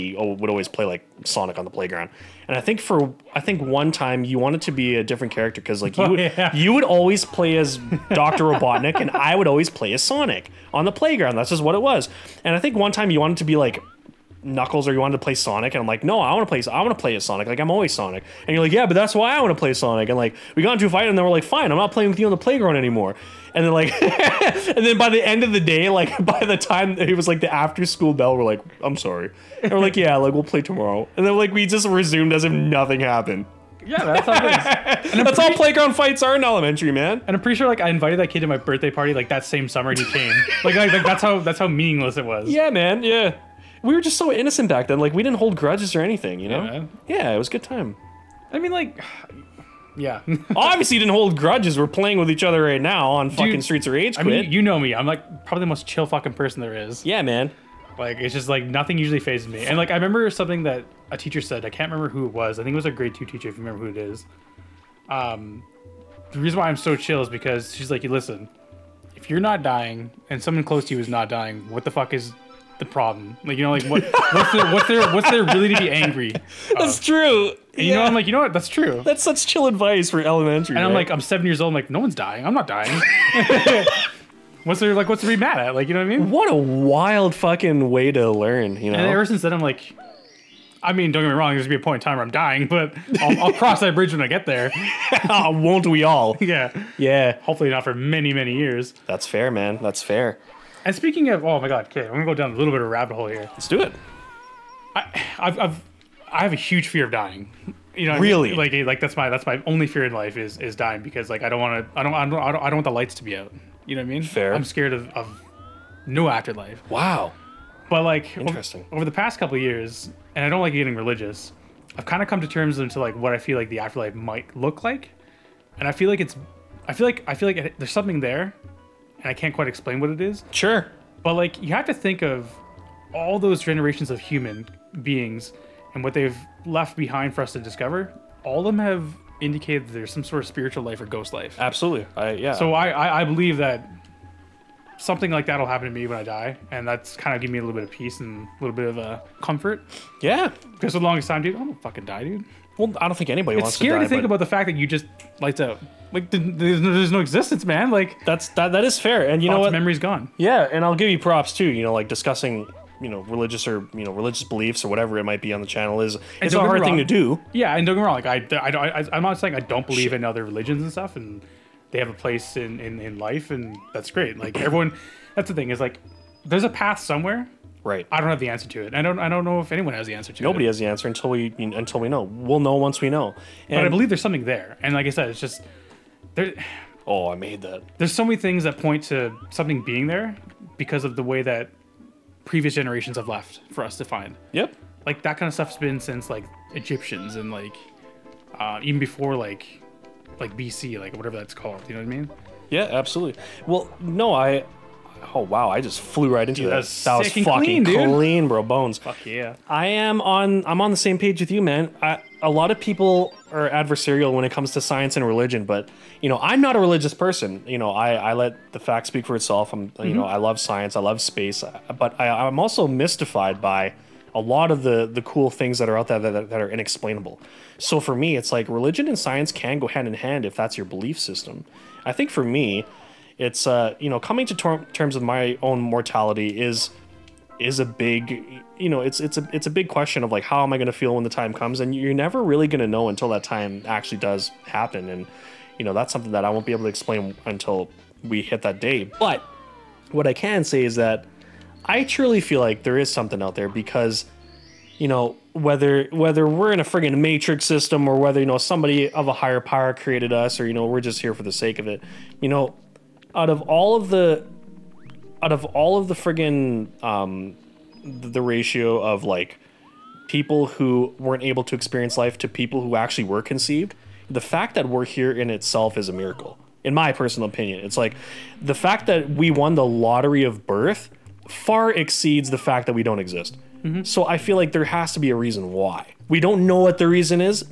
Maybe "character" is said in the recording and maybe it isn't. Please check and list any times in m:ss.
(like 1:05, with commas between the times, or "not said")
0:05.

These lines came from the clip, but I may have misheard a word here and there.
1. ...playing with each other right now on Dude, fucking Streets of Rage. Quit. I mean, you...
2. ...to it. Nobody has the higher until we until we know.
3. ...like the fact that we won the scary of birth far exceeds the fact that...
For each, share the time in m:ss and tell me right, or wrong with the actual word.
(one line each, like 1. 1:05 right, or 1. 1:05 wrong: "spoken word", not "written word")
1. 0:51 right
2. 3:00 wrong: "answer", not "higher"
3. 4:37 wrong: "lottery", not "scary".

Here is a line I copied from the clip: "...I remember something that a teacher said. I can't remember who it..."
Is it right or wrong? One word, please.
right.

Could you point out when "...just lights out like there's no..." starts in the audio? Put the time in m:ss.
2:34.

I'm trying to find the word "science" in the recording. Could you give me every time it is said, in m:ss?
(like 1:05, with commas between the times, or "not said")
3:34, 3:40, 3:49.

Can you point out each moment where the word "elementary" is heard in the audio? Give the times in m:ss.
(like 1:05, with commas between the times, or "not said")
0:36, 1:20.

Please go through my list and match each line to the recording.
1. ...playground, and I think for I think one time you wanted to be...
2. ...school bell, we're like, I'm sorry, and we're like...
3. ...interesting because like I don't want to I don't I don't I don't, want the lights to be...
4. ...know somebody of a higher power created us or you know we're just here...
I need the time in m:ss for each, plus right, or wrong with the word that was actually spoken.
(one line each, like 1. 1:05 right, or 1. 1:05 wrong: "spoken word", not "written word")
1. 0:01 right
2. 0:27 right
3. 1:50 wrong: "dying", not "interesting"
4. 4:18 right.